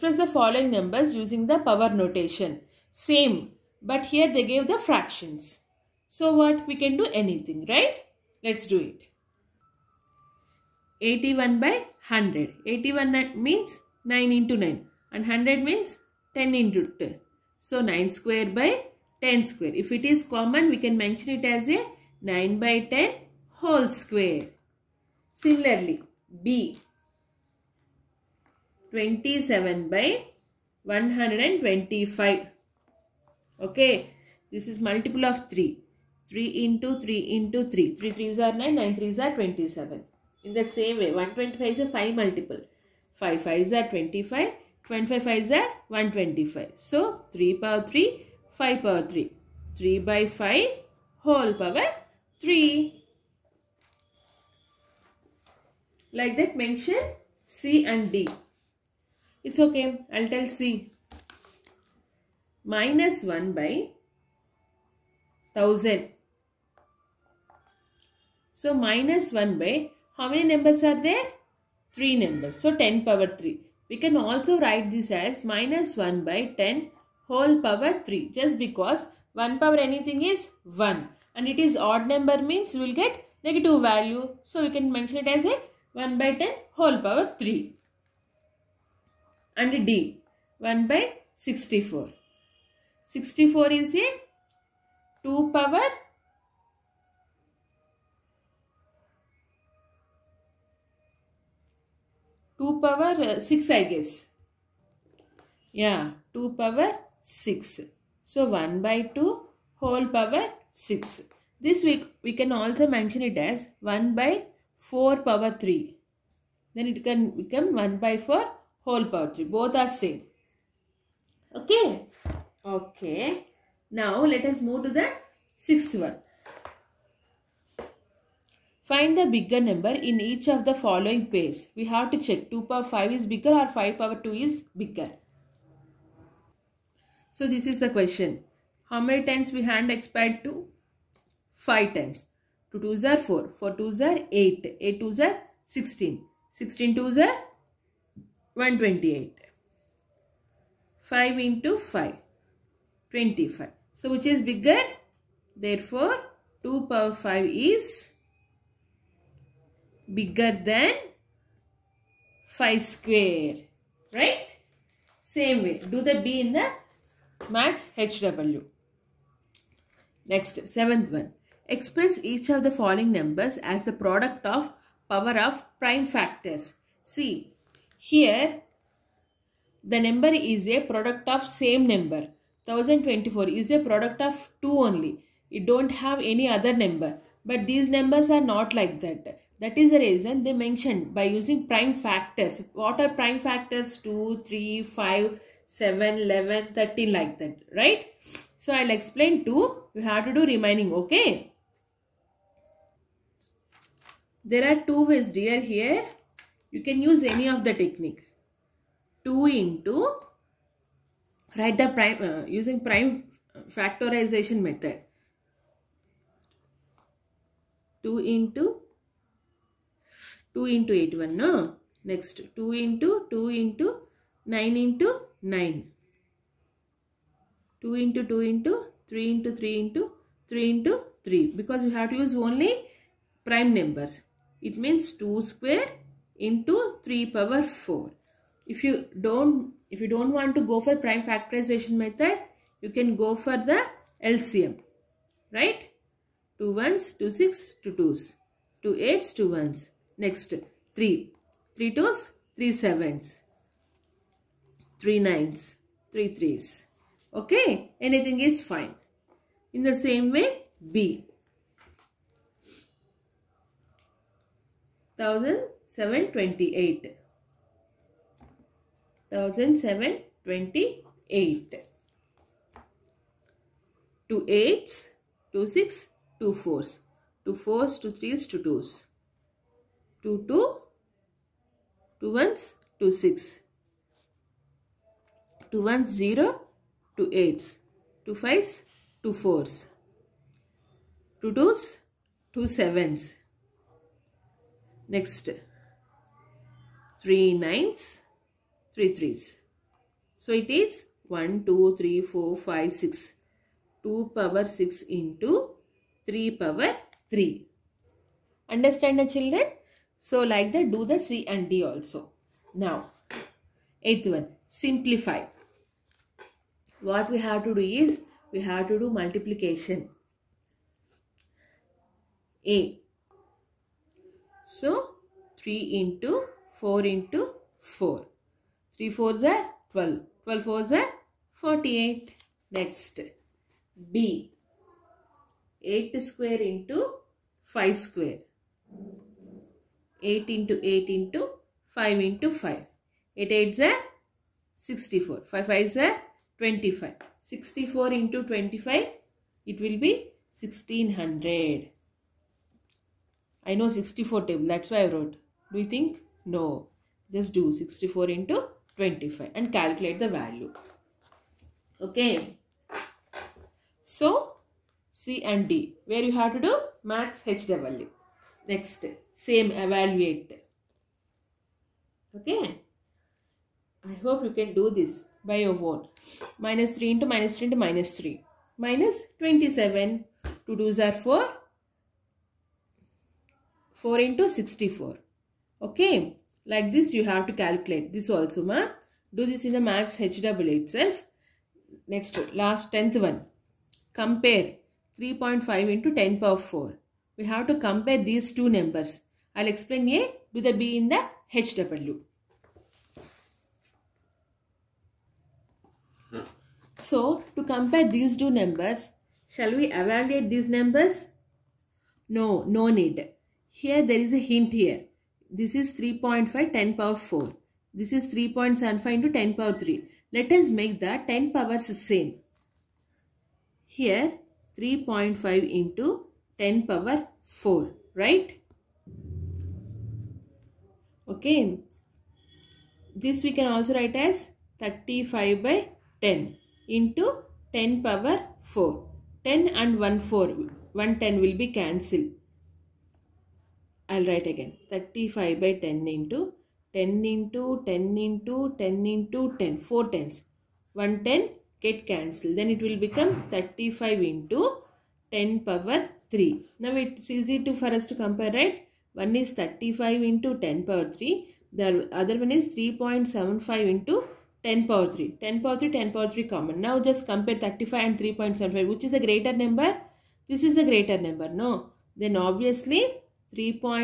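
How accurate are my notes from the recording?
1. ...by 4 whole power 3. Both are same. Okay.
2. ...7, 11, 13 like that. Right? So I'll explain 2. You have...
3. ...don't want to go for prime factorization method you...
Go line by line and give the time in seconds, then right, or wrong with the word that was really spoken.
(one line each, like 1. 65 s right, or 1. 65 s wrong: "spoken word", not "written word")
1. 117 s right
2. 195 s right
3. 240 s right.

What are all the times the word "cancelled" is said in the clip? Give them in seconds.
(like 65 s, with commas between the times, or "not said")
441 s, 452 s.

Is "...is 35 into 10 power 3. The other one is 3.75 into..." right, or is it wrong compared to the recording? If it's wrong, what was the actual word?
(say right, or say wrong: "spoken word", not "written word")
right.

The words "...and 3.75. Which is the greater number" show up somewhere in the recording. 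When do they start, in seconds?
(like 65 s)
468 s.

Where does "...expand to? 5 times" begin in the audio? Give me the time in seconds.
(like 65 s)
139 s.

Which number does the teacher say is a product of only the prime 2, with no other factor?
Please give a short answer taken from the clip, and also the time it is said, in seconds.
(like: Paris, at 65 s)
1024, at 182 s.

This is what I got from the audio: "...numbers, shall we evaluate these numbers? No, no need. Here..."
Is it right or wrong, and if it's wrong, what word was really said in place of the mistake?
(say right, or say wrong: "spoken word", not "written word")
right.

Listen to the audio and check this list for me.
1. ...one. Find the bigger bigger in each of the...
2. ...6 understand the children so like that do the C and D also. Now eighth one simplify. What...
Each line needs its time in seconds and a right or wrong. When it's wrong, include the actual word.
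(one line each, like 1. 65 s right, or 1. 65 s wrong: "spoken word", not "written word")
1. 125 s wrong: "number", not "bigger"
2. 307 s wrong: "3", not "6".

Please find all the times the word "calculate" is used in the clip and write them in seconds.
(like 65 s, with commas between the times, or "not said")
359 s, 387 s.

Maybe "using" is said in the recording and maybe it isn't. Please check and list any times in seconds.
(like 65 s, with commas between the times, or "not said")
1 s, 191 s, 212 s.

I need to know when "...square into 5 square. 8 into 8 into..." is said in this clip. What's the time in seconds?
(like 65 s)
336 s.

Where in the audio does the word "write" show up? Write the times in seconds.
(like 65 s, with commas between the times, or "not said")
74 s, 211 s, 433 s, 444 s.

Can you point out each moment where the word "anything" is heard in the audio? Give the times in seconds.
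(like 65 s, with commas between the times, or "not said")
7 s, 79 s, 258 s.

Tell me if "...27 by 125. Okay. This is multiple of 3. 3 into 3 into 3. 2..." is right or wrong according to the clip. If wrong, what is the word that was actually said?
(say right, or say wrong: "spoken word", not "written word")
wrong: "3", not "2".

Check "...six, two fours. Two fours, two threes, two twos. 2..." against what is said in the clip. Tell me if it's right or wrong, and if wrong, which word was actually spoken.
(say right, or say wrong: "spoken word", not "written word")
right.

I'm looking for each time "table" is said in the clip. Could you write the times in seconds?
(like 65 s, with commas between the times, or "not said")
354 s.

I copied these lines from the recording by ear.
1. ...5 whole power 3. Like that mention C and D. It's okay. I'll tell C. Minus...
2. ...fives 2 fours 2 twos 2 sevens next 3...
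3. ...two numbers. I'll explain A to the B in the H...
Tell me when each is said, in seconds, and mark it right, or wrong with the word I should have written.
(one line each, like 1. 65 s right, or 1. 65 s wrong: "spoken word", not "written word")
1. 50 s right
2. 288 s right
3. 398 s right.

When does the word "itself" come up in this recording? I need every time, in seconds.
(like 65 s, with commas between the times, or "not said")
390 s.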